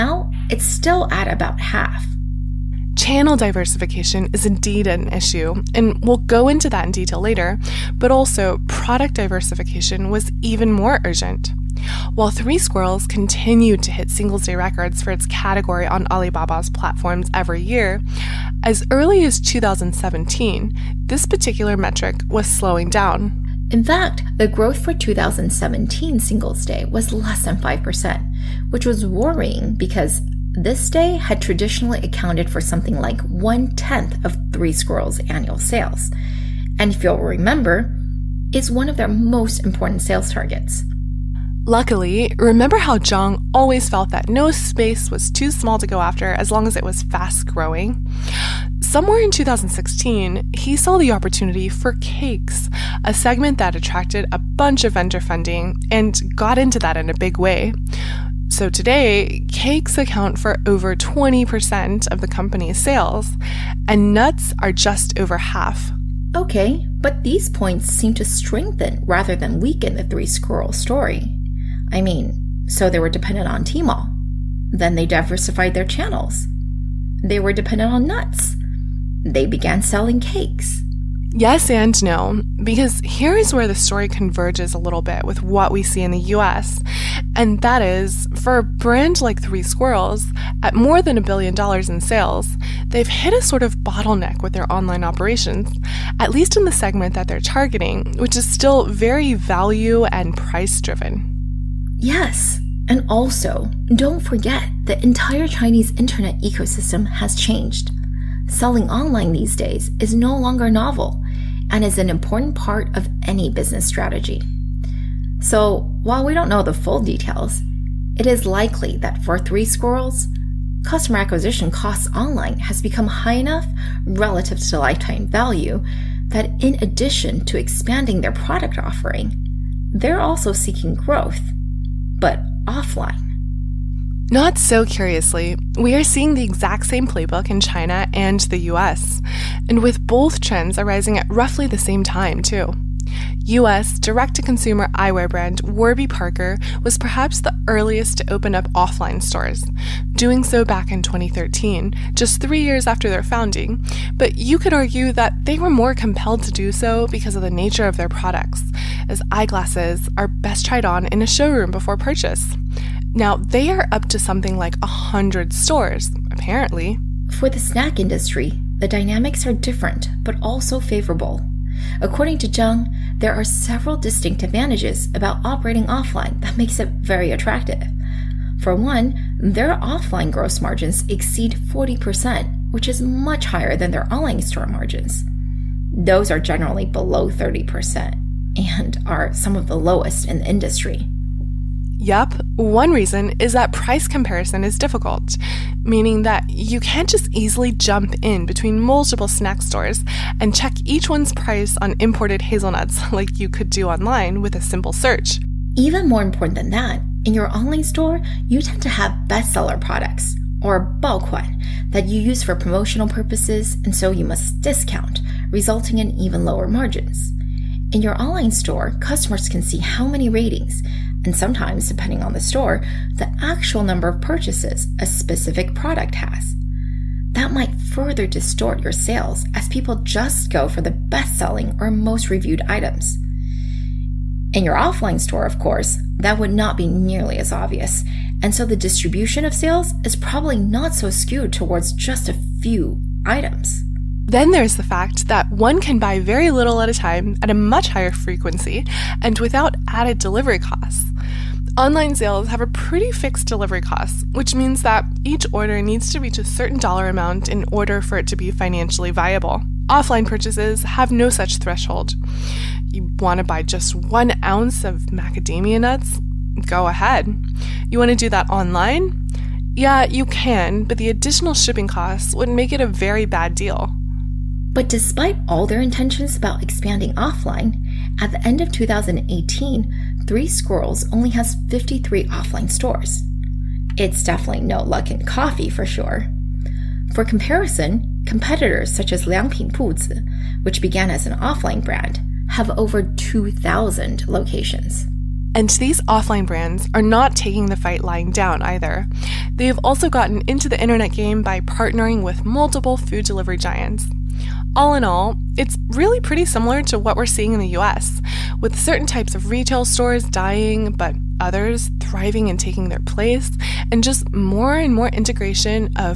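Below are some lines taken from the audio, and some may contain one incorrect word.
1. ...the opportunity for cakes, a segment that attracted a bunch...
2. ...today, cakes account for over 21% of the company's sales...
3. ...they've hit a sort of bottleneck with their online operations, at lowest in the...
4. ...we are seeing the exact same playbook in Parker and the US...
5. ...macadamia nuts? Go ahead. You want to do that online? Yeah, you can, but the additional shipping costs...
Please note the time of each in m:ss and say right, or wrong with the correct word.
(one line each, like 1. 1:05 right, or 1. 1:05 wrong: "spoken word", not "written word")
1. 0:50 right
2. 0:58 wrong: "20", not "21"
3. 1:32 wrong: "least", not "lowest"
4. 2:15 wrong: "China", not "Parker"
5. 4:25 right.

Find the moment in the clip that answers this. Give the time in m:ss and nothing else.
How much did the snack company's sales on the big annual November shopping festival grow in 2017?
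0:27.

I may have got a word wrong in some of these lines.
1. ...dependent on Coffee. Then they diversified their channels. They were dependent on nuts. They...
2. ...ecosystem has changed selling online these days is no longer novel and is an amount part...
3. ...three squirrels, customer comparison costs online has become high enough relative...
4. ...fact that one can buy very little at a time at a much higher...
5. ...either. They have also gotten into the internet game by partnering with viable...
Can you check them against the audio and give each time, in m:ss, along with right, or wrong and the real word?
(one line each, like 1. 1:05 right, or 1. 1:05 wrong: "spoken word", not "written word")
1. 1:13 wrong: "Tmall", not "Coffee"
2. 1:46 wrong: "important", not "amount"
3. 1:59 wrong: "acquisition", not "comparison"
4. 4:04 right
5. 4:58 wrong: "multiple", not "viable".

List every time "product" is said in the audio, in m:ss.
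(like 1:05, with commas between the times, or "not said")
0:08, 2:08, 2:38, 3:29, 3:45.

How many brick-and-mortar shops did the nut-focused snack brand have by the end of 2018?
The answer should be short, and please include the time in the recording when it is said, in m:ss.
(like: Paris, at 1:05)
53, at 4:41.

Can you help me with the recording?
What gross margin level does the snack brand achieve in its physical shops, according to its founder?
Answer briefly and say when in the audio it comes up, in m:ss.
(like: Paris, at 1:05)
over 40%, at 3:01.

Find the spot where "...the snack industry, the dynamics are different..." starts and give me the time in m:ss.
2:47.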